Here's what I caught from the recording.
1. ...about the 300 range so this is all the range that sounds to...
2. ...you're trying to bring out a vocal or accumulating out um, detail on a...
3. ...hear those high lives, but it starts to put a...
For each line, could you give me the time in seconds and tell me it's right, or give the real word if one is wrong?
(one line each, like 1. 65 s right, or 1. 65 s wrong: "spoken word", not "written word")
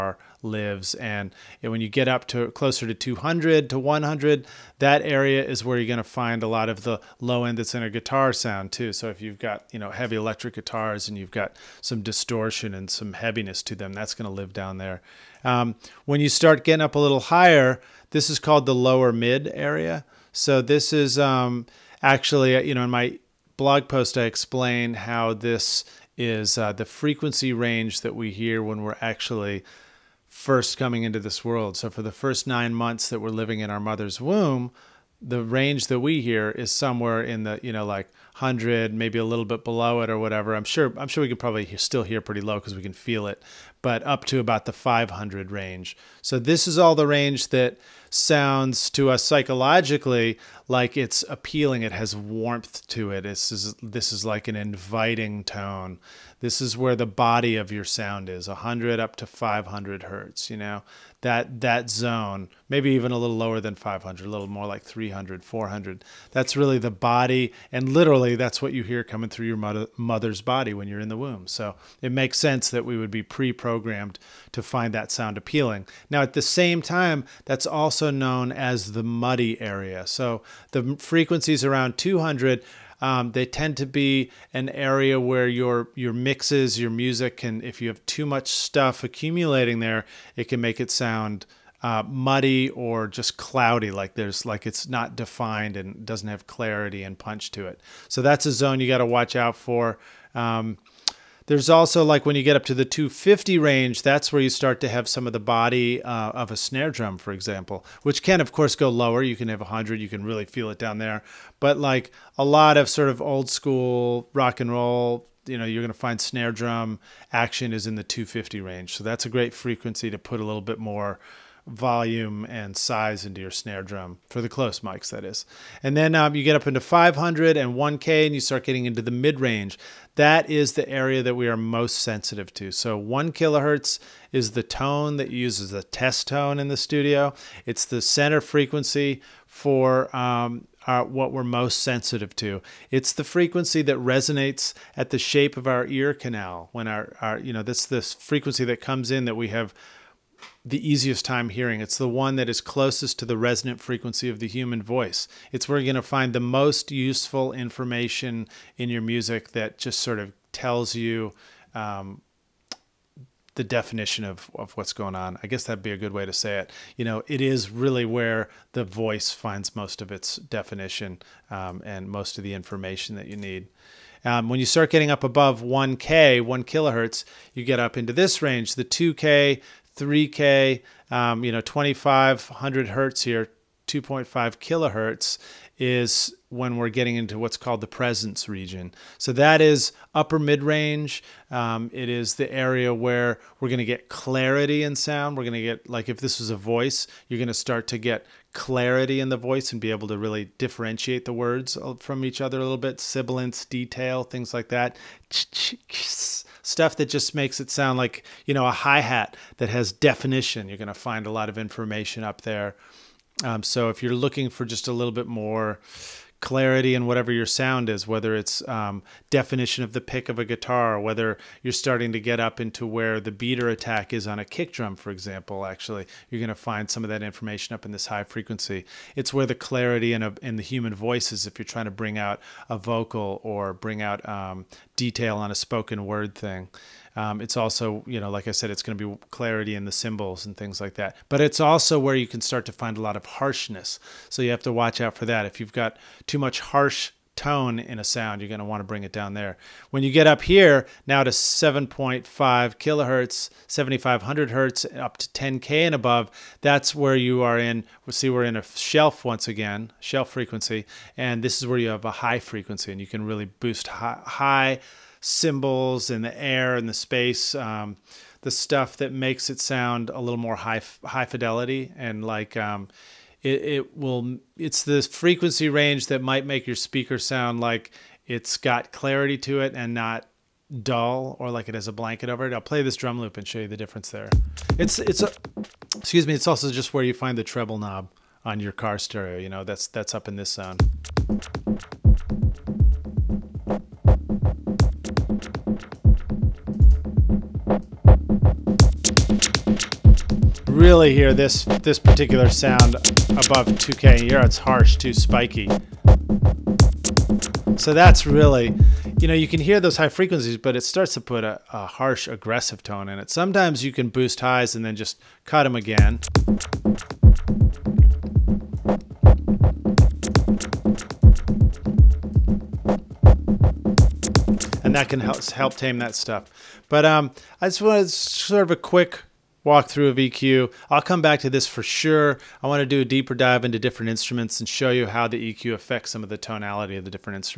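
1. 44 s wrong: "500", not "300"
2. 231 s wrong: "bring", not "accumulating"
3. 309 s wrong: "frequencies", not "lives".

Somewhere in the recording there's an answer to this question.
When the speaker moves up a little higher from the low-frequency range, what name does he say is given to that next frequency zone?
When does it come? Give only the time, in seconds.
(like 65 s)
18 s.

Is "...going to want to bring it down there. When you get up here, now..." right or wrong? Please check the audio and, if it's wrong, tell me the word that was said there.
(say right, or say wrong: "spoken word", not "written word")
right.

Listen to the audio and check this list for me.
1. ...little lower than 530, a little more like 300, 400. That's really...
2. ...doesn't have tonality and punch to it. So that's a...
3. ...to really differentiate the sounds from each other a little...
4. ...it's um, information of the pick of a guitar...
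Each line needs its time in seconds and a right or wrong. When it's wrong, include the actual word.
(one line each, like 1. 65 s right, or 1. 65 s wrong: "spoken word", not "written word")
1. 63 s wrong: "500", not "530"
2. 96 s wrong: "clarity", not "tonality"
3. 200 s wrong: "words", not "sounds"
4. 218 s wrong: "definition", not "information".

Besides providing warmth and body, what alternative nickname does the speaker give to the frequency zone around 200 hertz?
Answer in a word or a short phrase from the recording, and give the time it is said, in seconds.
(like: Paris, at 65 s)
muddy area, at 79 s.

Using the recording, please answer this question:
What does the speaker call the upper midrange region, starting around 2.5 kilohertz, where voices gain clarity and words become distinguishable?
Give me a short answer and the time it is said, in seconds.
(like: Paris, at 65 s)
presence region, at 187 s.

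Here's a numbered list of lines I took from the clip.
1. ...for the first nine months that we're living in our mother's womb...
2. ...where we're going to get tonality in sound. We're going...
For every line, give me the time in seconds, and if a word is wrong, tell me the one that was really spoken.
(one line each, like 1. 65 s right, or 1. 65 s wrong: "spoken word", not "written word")
1. 31 s right
2. 192 s wrong: "clarity", not "tonality".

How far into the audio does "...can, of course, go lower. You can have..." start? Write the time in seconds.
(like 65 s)
108 s.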